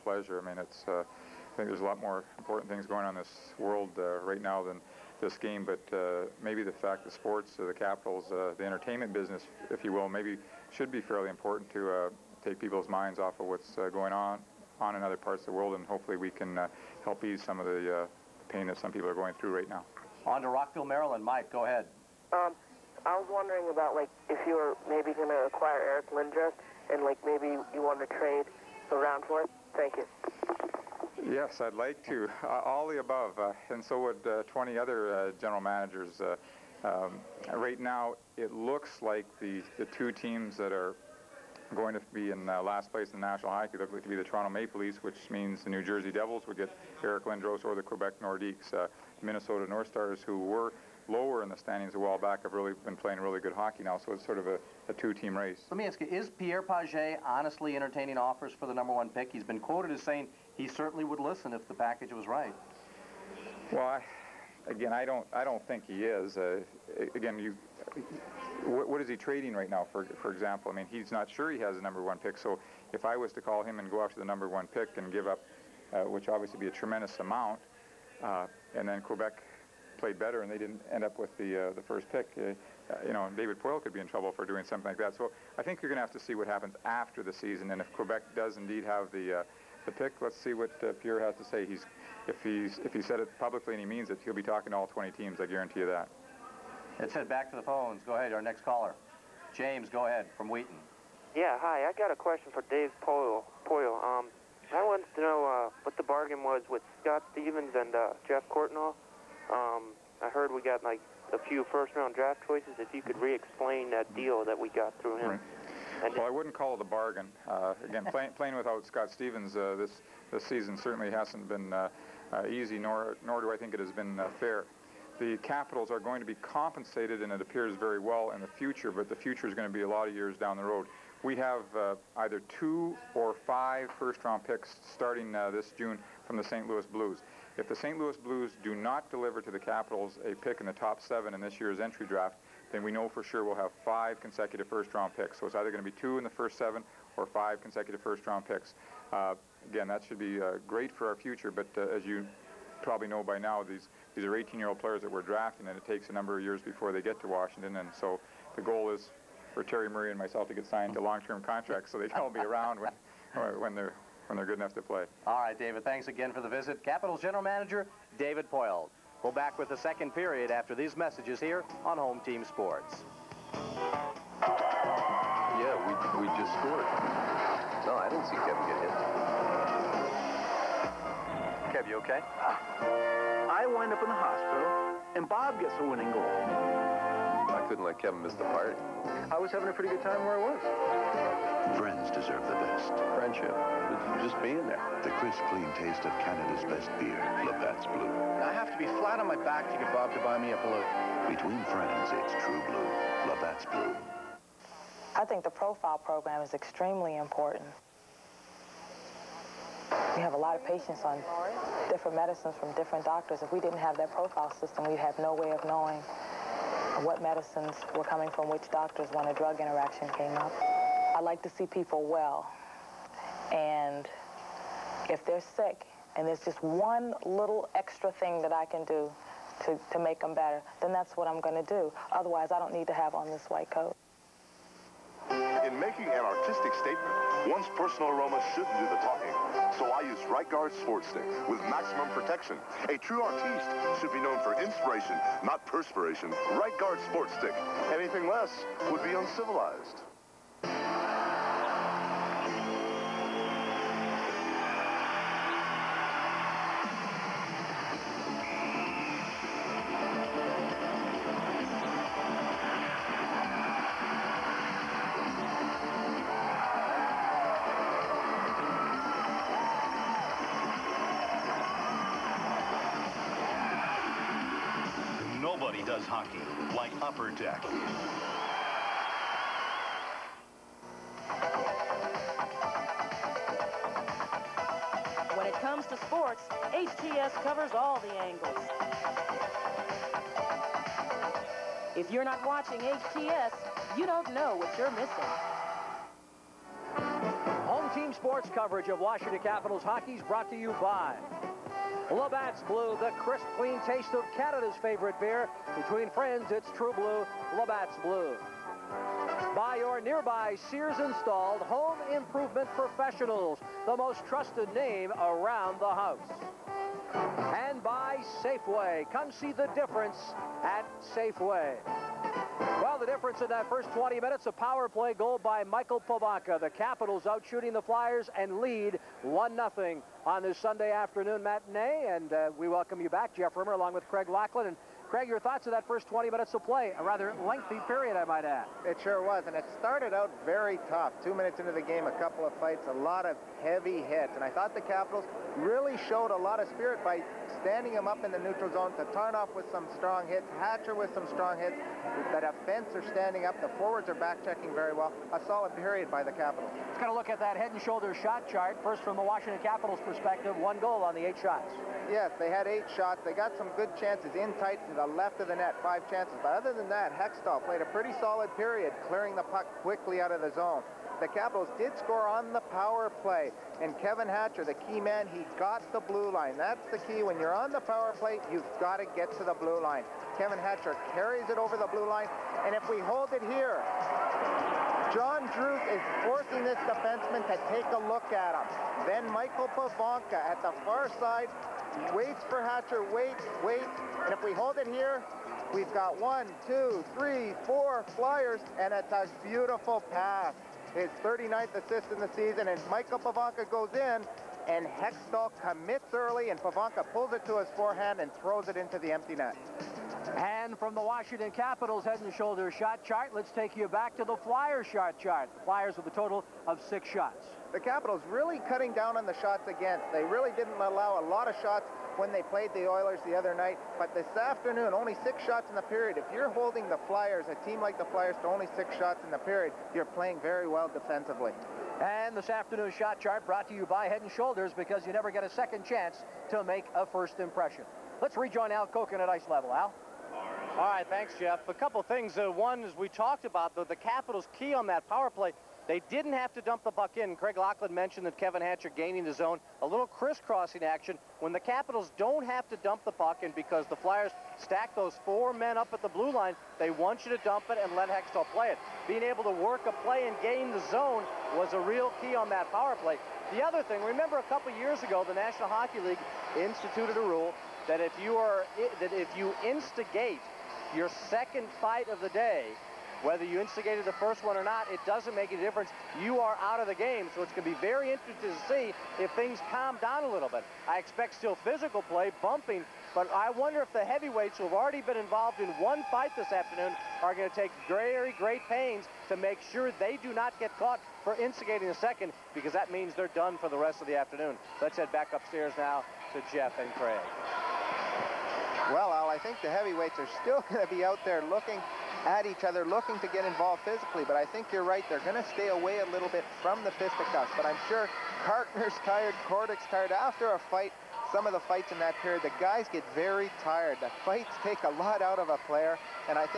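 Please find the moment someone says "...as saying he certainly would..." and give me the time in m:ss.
0:59.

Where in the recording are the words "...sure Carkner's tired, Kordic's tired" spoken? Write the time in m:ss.
8:27.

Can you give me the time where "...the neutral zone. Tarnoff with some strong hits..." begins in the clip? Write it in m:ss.
5:48.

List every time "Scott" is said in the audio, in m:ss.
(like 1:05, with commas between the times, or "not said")
1:46, 1:58.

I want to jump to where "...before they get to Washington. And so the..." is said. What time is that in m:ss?
2:36.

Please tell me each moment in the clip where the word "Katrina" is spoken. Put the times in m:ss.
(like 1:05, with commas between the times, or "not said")
not said.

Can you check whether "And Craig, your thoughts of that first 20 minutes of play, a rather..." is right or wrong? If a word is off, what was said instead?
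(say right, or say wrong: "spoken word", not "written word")
right.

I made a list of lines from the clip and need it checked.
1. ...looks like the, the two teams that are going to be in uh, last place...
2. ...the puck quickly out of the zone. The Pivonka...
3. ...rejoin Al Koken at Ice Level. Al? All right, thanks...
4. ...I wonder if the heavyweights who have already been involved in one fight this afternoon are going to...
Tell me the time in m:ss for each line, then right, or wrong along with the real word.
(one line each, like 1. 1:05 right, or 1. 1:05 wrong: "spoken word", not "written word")
1. 0:38 right
2. 6:09 wrong: "Capitals", not "Pivonka"
3. 7:18 right
4. 8:03 right.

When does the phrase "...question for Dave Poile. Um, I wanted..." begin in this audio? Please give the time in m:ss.
1:42.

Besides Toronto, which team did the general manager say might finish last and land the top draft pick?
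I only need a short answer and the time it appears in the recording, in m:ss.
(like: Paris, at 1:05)
Quebec Nordiques, at 0:47.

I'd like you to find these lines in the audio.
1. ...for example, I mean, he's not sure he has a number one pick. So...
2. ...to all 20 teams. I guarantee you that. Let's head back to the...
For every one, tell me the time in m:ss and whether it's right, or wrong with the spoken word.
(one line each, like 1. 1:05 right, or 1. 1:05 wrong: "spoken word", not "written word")
1. 1:10 right
2. 1:34 right.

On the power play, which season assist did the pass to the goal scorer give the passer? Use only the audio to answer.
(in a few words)
39th.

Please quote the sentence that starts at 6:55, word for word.
The Flyers with a total of six shots.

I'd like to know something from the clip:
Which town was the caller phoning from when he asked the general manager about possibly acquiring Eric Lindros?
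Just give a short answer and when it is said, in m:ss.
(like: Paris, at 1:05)
Rockville, Maryland, at 0:20.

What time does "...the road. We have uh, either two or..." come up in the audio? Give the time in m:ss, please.
2:10.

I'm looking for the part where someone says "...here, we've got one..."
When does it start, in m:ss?
6:34.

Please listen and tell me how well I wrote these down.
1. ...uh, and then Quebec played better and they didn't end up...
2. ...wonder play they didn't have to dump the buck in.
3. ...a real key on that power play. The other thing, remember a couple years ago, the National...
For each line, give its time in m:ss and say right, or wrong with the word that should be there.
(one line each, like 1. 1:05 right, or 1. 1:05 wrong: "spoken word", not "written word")
1. 1:18 right
2. 7:25 wrong: "power", not "wonder"
3. 7:41 right.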